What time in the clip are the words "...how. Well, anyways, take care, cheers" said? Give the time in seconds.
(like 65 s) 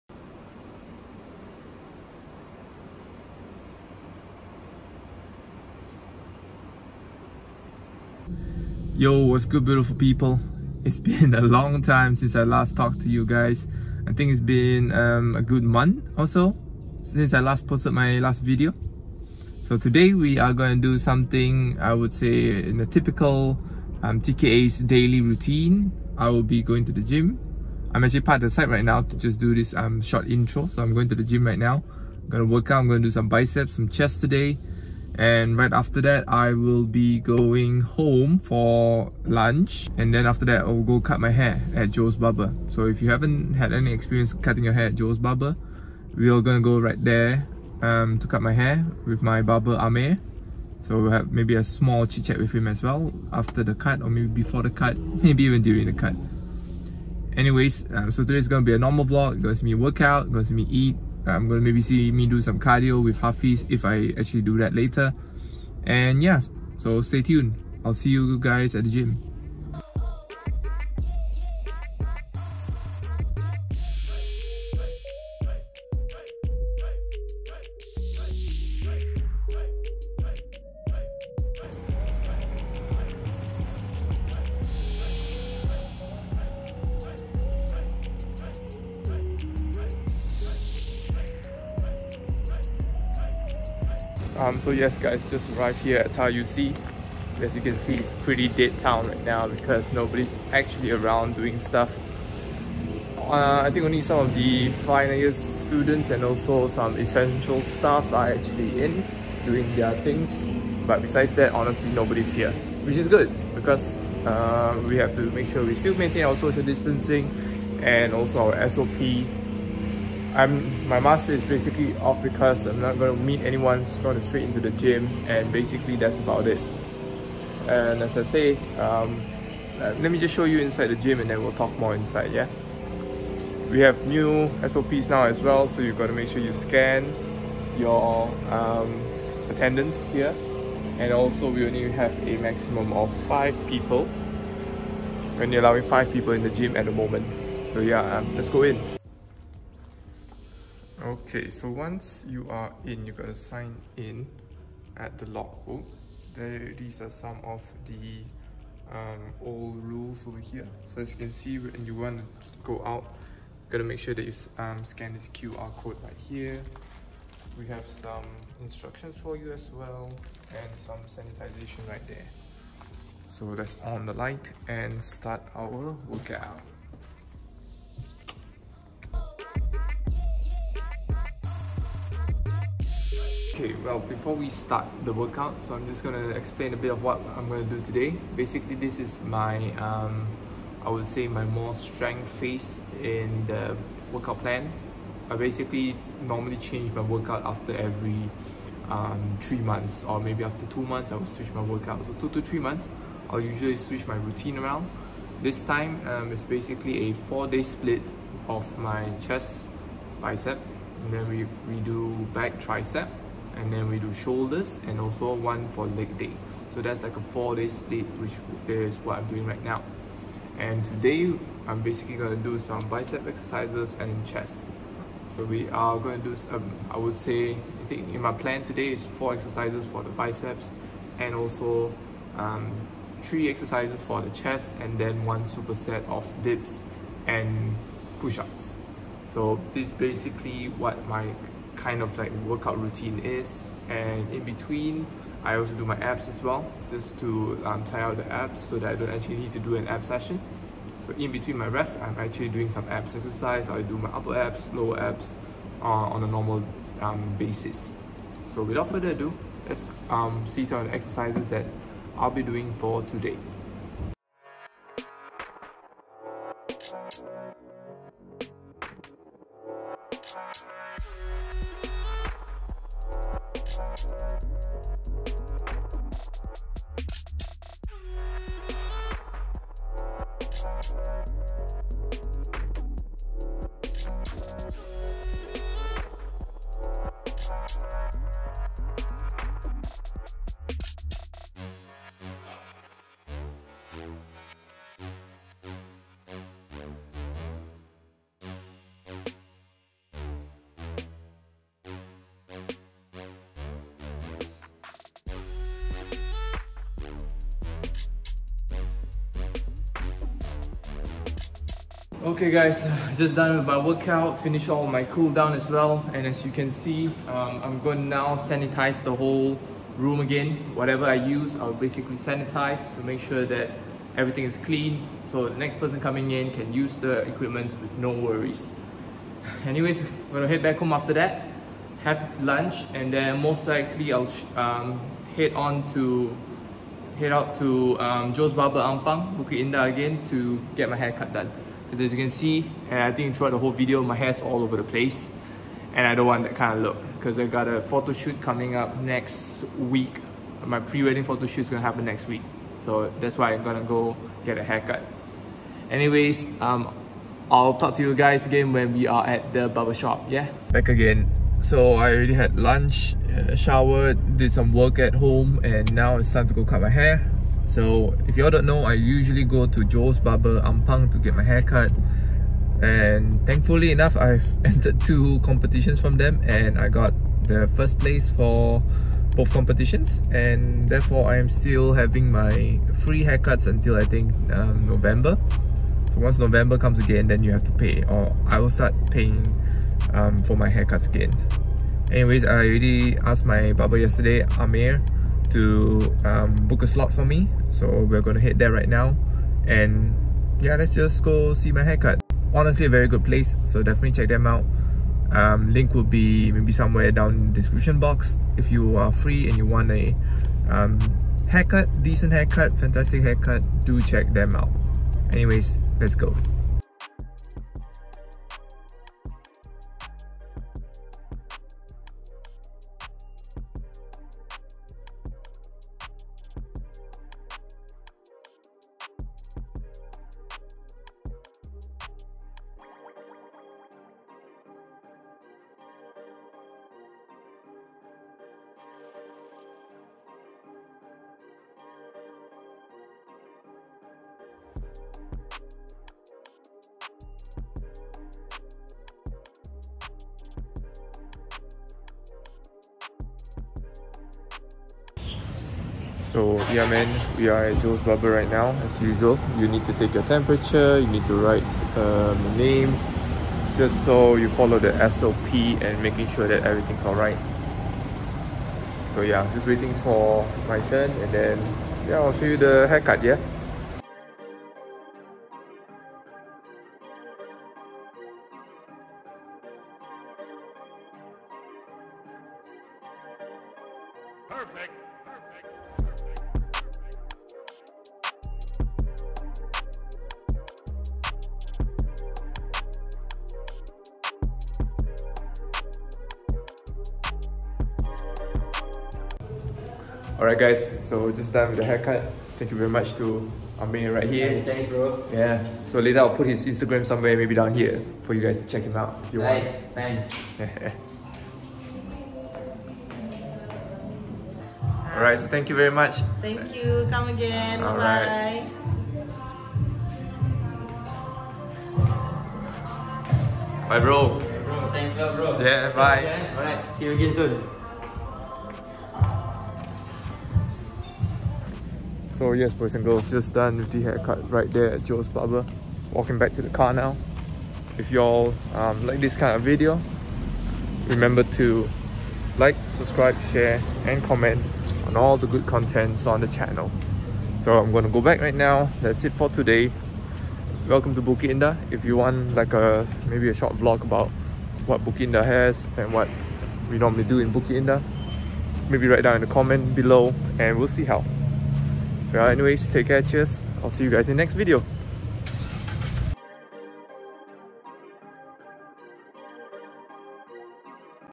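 561 s.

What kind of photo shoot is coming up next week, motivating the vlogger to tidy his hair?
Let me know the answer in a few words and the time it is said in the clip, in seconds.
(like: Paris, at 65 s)
pre-wedding, at 350 s.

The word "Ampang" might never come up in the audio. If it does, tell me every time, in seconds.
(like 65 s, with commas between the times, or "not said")
338 s, 370 s.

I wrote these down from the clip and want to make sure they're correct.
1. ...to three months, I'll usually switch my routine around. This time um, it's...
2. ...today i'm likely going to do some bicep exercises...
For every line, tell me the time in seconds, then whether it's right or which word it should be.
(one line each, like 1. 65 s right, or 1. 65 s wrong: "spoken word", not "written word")
1. 202 s right
2. 220 s wrong: "basically", not "likely".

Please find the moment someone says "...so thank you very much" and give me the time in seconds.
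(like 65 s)
515 s.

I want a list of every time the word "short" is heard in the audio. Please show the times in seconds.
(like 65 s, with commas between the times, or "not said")
30 s, 553 s.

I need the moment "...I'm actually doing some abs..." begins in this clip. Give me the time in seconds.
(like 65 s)
251 s.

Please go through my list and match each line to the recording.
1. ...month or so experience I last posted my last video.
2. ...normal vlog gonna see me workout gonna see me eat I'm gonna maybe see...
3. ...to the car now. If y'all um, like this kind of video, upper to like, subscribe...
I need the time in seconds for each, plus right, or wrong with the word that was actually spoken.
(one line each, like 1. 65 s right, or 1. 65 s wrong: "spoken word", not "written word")
1. 15 s wrong: "since", not "experience"
2. 58 s right
3. 536 s wrong: "remember", not "upper".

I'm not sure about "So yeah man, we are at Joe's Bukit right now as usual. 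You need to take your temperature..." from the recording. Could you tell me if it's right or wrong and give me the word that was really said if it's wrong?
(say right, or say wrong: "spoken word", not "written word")
wrong: "Barber", not "Bukit".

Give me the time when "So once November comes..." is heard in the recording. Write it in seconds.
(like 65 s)
386 s.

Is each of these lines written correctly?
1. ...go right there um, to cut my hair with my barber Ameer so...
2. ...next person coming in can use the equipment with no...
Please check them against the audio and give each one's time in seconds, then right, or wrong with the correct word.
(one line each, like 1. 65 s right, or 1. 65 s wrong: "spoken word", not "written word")
1. 46 s right
2. 325 s right.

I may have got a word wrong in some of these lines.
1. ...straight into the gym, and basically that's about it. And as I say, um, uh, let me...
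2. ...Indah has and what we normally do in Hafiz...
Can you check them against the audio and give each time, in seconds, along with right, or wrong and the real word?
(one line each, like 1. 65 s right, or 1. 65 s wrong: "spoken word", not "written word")
1. 124 s right
2. 555 s wrong: "Indah", not "Hafiz".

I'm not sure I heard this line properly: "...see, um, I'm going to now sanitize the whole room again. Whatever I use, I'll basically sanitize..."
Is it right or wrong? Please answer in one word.
right.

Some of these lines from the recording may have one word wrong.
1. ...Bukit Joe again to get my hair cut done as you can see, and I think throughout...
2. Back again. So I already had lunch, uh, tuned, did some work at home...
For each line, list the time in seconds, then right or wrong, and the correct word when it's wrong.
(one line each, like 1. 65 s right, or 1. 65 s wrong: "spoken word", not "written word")
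1. 339 s wrong: "Indah", not "Joe"
2. 360 s wrong: "showered", not "tuned".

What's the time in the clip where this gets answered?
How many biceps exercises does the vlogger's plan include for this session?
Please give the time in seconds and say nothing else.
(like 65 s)
229 s.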